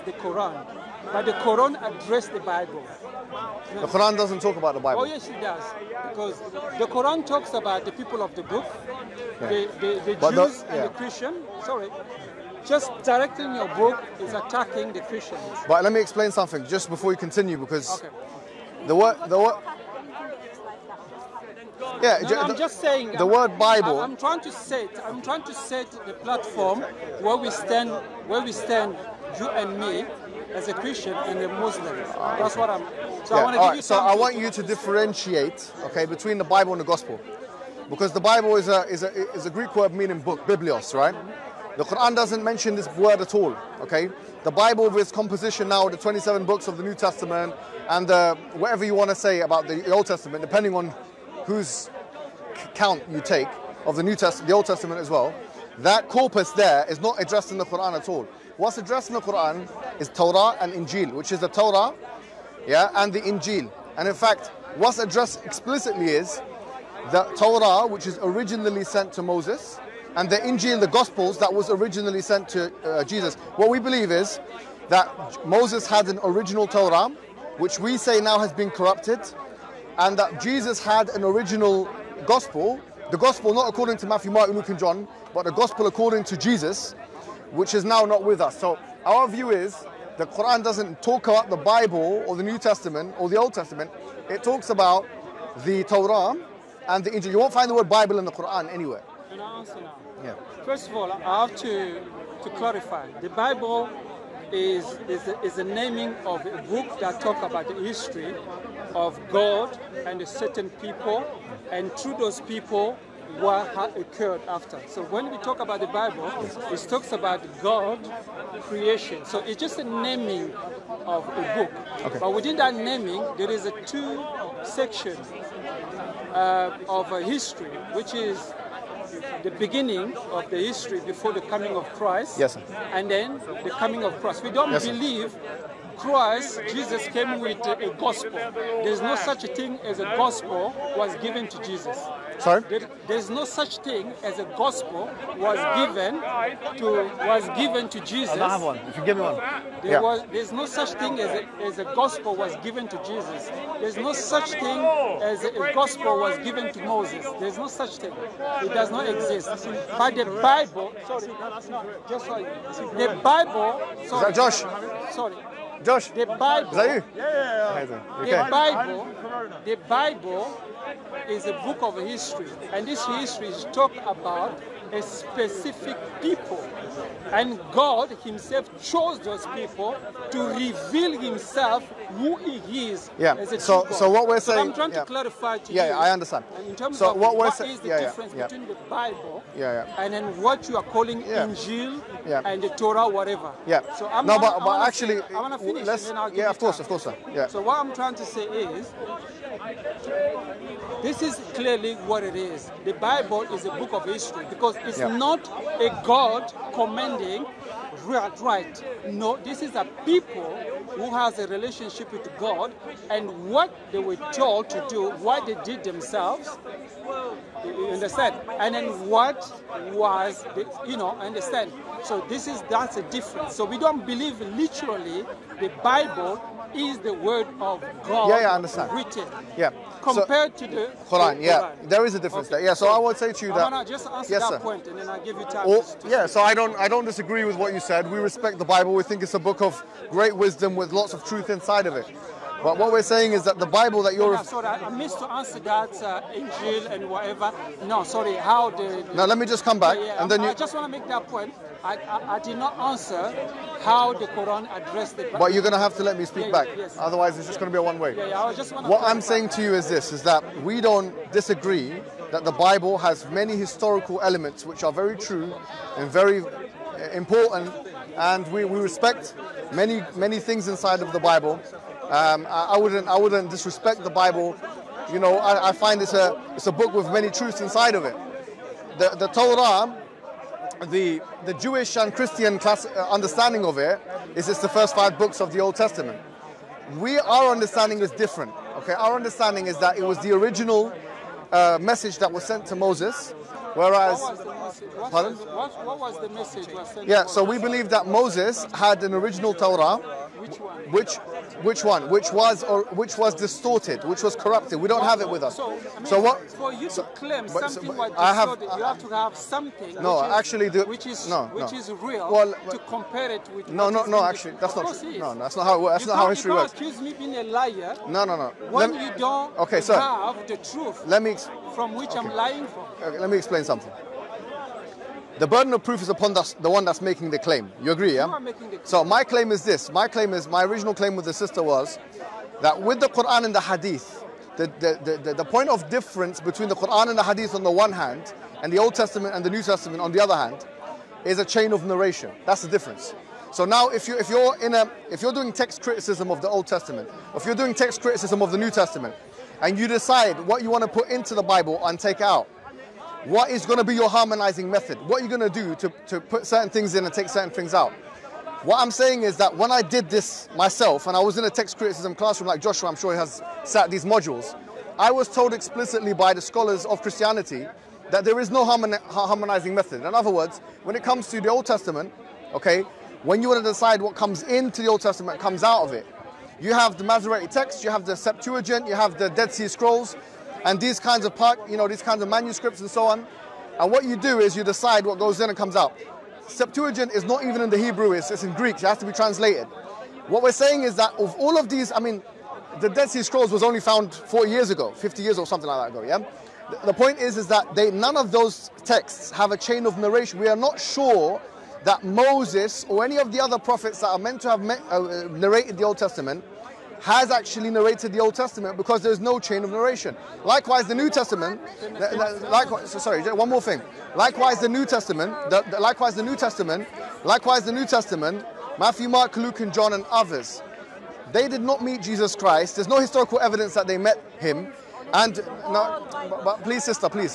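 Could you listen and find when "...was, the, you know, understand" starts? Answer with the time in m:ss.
3:39.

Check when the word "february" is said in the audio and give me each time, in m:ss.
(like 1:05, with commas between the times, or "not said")
not said.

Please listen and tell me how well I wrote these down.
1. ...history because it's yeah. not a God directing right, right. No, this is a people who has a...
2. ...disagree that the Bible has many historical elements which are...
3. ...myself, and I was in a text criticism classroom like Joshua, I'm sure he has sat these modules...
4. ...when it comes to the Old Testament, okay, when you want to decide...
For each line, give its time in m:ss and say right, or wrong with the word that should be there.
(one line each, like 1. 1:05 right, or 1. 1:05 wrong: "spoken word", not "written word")
1. 3:24 wrong: "commanding", not "directing"
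2. 4:21 right
3. 6:00 right
4. 6:10 right.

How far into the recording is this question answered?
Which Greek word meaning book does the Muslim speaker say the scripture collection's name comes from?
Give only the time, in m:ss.
0:40.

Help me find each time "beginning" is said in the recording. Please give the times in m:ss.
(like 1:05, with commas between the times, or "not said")
2:09.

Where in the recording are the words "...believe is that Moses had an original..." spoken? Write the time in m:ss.
1:13.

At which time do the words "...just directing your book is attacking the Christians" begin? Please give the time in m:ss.
0:12.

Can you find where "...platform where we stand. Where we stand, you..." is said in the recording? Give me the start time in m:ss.
0:26.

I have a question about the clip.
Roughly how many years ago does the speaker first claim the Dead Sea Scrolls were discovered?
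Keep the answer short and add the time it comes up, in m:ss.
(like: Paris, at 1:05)
40, at 6:34.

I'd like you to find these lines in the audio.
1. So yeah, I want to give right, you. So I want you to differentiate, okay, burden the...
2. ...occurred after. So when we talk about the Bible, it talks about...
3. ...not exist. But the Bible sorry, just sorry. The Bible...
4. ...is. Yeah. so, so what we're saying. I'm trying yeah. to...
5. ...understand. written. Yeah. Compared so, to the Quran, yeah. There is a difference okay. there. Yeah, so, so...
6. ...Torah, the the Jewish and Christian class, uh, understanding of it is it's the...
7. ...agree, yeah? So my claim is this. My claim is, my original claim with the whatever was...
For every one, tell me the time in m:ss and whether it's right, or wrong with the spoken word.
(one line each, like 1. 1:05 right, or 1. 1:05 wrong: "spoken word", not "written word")
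1. 0:33 wrong: "between", not "burden"
2. 1:53 right
3. 2:38 right
4. 3:02 right
5. 3:48 right
6. 4:39 right
7. 5:27 wrong: "sister", not "whatever".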